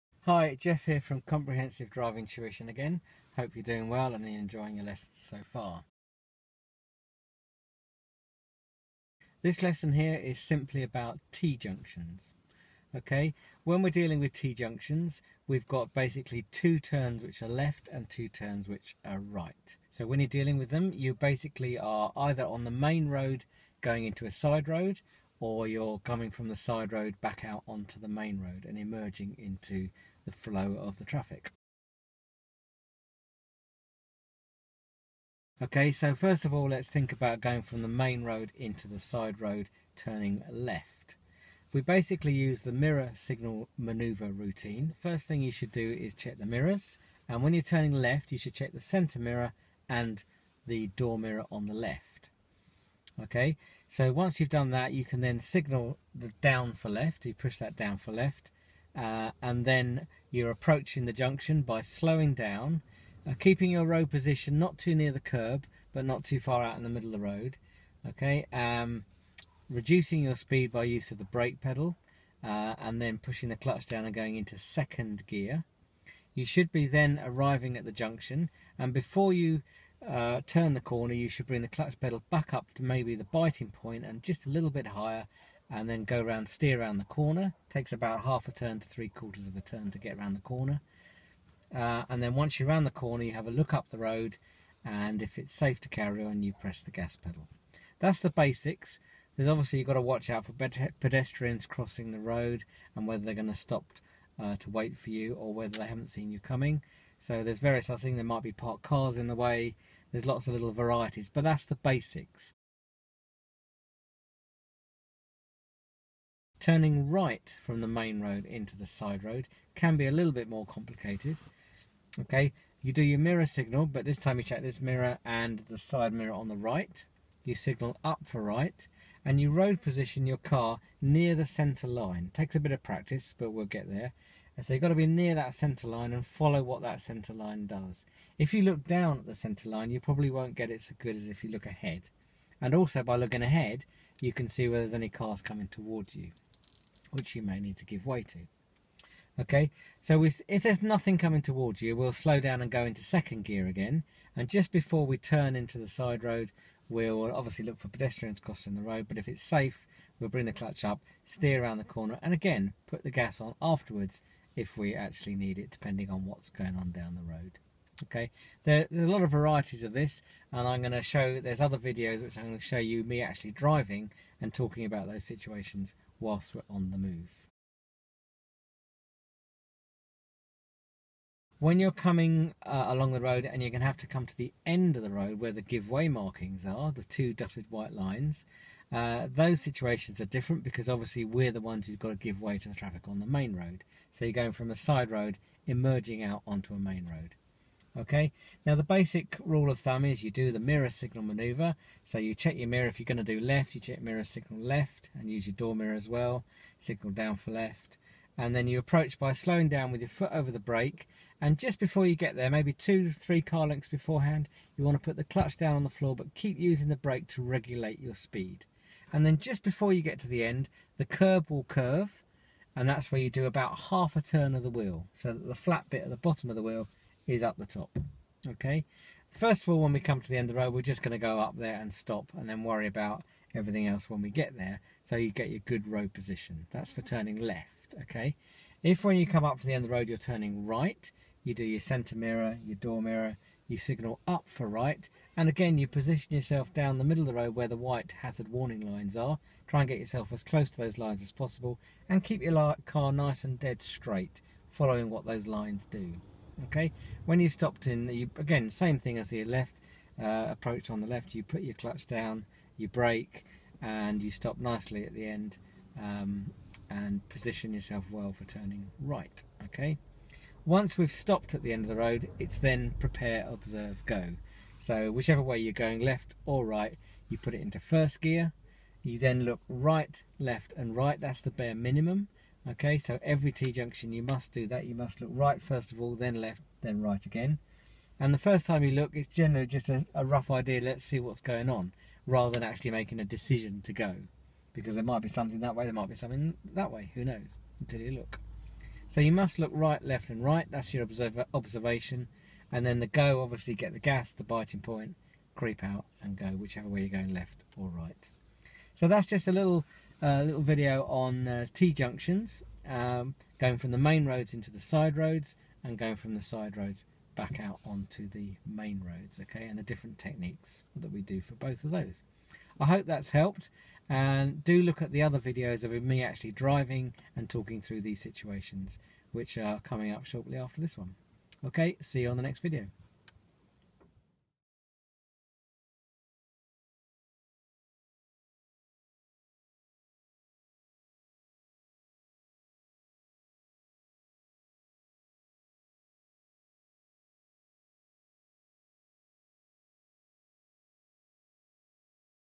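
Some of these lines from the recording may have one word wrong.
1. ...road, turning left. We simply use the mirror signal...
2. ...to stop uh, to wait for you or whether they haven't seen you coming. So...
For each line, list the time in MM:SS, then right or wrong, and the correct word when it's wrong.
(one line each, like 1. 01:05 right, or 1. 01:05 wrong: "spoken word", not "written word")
1. 00:39 wrong: "basically", not "simply"
2. 01:43 right.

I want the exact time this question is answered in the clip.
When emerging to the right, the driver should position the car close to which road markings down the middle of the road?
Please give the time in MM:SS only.
04:07.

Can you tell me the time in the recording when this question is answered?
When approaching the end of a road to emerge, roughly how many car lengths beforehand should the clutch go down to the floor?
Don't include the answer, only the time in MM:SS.
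03:32.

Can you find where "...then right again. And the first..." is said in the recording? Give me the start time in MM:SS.
04:46.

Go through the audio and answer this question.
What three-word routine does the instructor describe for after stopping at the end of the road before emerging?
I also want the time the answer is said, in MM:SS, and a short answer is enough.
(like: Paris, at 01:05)
prepare observe go, at 04:32.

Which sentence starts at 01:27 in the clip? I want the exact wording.
Takes about half a turn to three quarters of a turn to get around the corner.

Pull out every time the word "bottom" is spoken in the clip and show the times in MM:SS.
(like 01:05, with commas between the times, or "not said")
03:46.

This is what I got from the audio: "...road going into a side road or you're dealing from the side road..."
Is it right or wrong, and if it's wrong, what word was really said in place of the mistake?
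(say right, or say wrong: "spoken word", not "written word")
wrong: "coming", not "dealing".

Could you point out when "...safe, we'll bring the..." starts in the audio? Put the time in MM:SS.
02:39.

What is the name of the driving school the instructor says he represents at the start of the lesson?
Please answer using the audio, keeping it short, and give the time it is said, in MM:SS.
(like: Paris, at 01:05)
Comprehensive Driving Tuition, at 00:01.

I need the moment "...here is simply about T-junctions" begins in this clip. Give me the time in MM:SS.
00:09.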